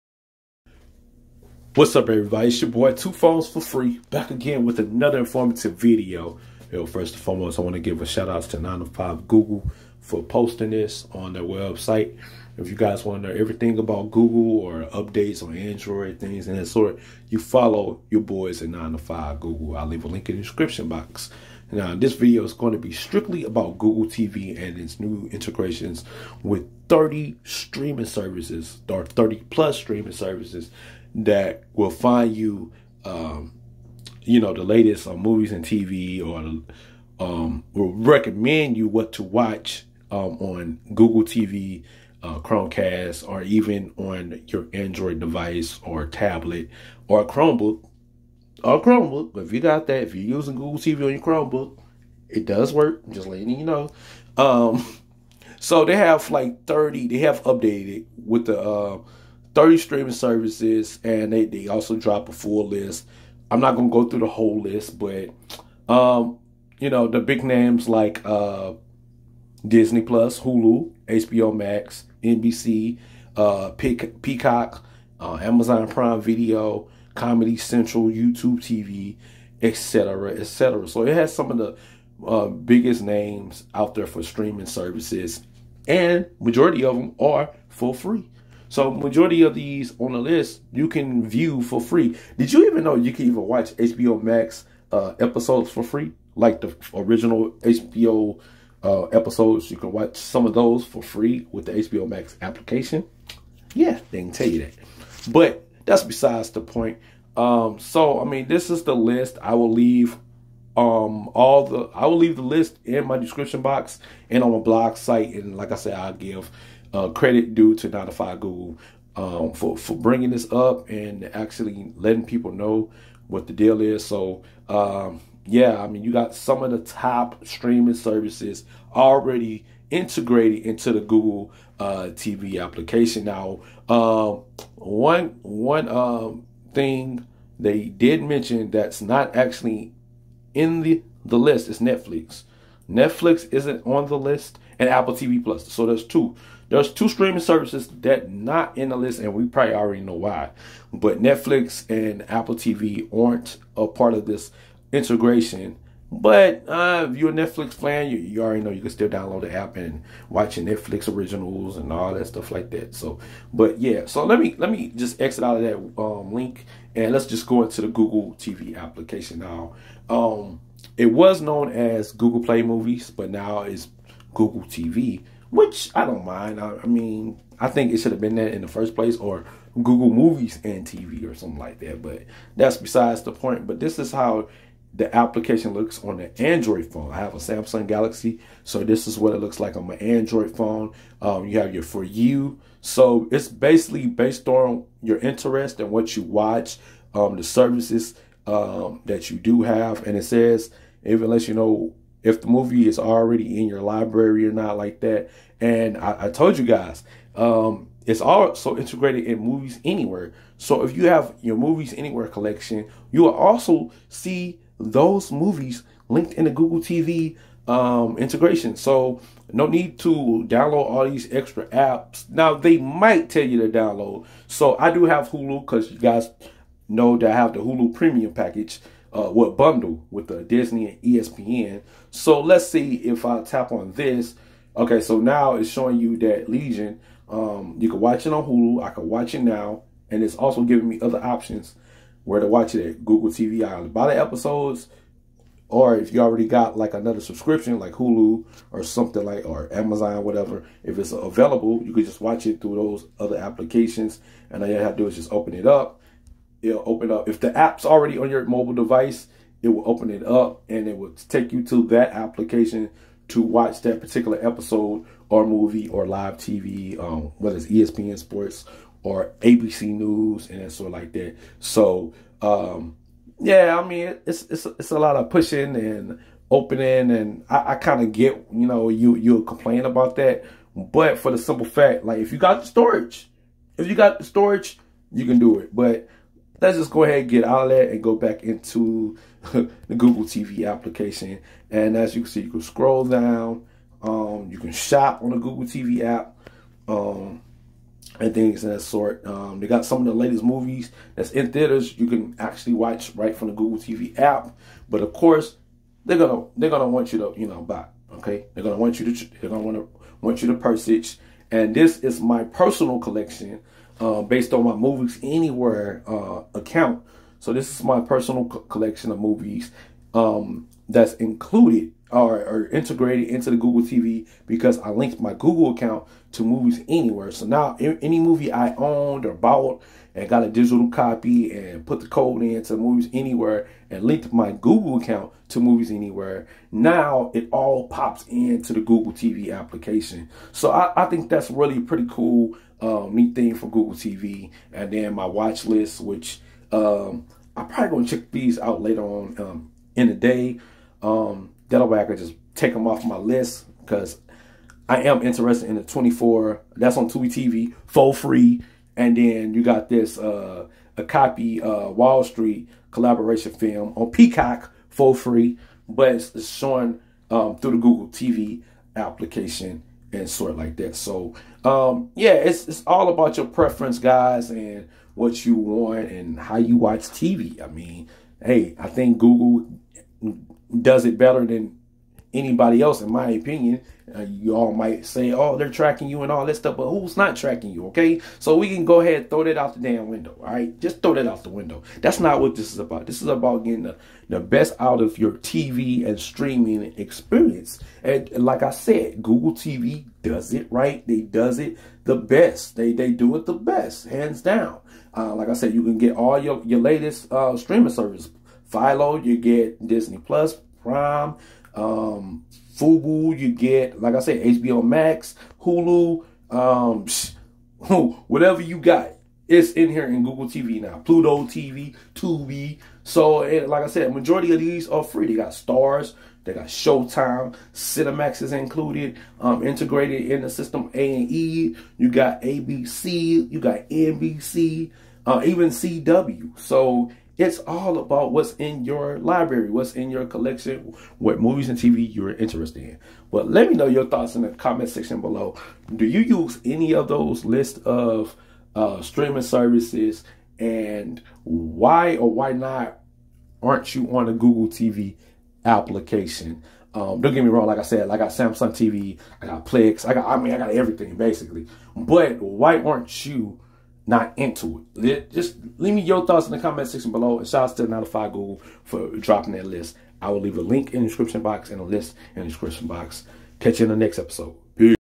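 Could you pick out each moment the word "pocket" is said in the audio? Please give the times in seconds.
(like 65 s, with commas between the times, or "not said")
not said.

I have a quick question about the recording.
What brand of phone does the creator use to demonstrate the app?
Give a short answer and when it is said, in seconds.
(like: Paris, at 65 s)
Samsung Galaxy, at 187 s.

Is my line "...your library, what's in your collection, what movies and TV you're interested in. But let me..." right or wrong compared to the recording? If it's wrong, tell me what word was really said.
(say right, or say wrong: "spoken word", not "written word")
right.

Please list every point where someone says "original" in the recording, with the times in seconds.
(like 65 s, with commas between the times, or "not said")
96 s, 161 s.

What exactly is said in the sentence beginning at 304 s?
But of course, they're gonna they're gonna want you to you know buy.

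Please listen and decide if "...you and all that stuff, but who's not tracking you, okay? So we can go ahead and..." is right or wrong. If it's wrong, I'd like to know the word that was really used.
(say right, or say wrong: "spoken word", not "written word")
right.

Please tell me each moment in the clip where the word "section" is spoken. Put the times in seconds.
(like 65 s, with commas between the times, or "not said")
444 s, 466 s.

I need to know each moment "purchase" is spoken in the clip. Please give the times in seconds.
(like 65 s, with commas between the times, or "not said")
310 s.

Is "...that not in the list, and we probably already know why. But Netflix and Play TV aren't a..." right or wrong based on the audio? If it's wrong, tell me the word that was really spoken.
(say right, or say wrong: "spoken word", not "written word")
wrong: "Apple", not "Play".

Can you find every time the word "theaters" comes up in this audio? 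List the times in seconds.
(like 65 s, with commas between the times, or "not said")
301 s.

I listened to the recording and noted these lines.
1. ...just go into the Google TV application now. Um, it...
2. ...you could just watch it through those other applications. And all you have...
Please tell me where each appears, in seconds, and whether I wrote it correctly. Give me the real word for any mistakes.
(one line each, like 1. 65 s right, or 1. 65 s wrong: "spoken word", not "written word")
1. 167 s right
2. 251 s right.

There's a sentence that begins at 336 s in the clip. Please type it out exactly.
Now it all pops into the Google TV application.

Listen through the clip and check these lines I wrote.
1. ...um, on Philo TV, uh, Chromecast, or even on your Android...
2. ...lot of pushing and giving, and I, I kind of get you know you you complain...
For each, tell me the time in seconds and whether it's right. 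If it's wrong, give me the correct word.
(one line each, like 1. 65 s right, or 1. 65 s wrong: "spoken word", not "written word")
1. 40 s wrong: "Google", not "Philo"
2. 274 s wrong: "opening", not "giving".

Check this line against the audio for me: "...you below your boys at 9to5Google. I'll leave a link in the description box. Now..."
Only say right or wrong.
wrong.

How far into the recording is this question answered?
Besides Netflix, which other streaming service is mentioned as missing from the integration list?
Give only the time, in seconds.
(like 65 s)
144 s.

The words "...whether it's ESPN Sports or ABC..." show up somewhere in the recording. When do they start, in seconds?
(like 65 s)
267 s.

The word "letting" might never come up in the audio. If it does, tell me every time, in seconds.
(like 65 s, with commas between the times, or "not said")
53 s, 121 s.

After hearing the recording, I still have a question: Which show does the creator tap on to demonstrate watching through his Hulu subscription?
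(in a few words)
Legion.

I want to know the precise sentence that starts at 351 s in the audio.
Um, Delaware, I could just take them off my list because I am interested in the 24.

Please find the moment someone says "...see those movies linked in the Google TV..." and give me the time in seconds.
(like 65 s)
214 s.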